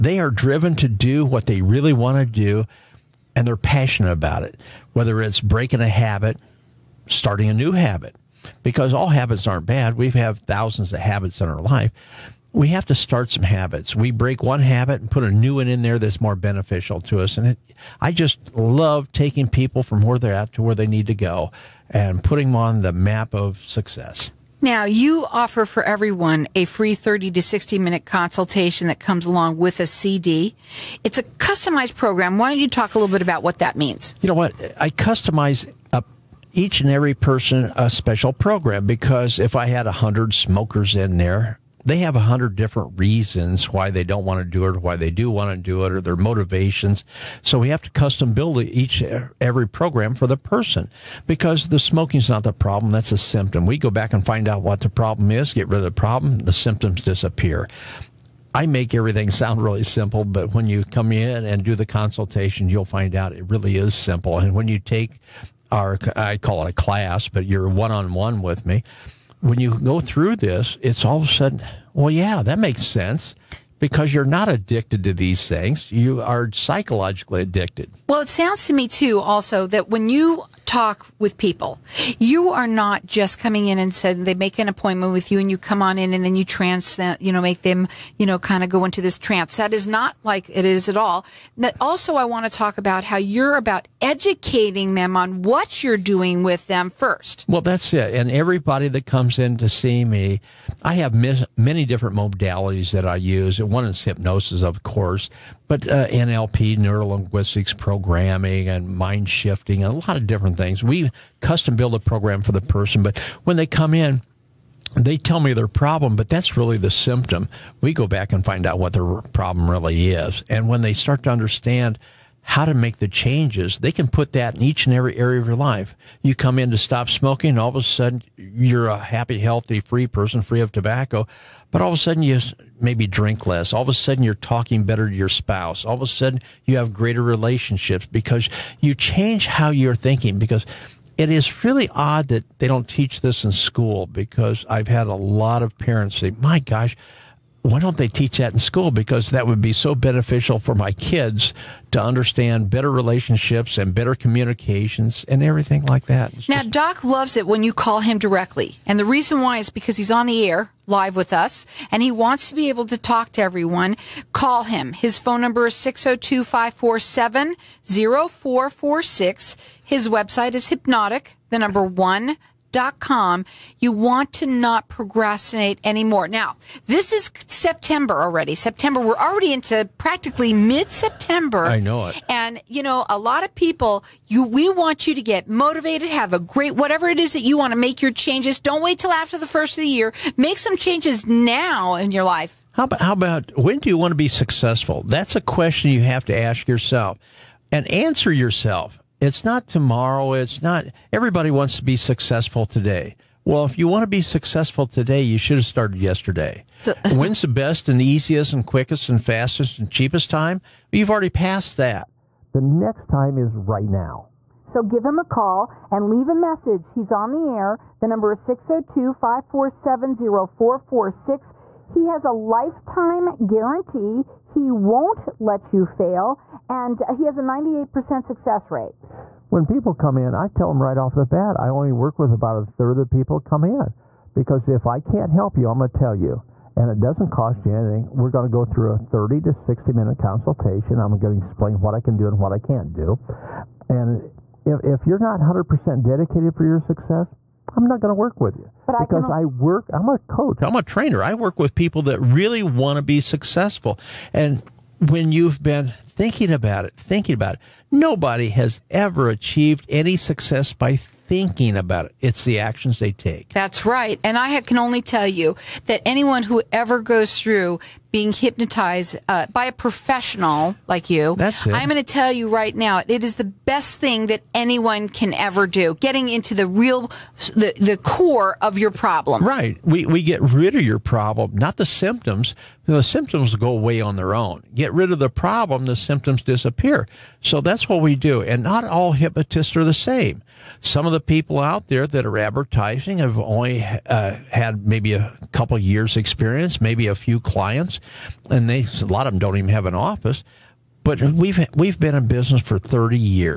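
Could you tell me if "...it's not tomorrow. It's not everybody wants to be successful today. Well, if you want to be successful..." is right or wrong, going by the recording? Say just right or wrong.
right.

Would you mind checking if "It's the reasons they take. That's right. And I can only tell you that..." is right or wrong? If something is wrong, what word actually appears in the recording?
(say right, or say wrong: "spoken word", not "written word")
wrong: "actions", not "reasons".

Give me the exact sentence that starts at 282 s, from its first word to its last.
The symptoms go away on their own.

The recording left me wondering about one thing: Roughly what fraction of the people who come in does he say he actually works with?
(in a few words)
a third.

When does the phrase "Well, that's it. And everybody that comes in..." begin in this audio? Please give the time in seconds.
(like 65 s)
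97 s.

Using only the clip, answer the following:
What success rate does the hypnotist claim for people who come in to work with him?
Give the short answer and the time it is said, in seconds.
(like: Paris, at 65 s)
98%, at 227 s.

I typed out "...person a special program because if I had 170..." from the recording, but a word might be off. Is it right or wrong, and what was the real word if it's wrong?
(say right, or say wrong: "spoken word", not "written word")
wrong: "100", not "170".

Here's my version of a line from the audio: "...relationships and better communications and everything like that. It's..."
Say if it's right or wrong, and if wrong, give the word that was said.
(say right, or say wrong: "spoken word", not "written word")
right.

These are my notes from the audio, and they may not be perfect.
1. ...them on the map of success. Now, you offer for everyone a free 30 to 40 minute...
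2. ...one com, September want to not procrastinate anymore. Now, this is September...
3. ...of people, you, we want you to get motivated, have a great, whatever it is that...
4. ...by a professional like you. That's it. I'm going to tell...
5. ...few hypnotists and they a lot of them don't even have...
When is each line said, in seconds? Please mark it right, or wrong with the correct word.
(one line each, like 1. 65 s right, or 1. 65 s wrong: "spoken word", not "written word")
1. 22 s wrong: "60", not "40"
2. 171 s wrong: "You", not "September"
3. 183 s right
4. 269 s right
5. 297 s wrong: "clients", not "hypnotists".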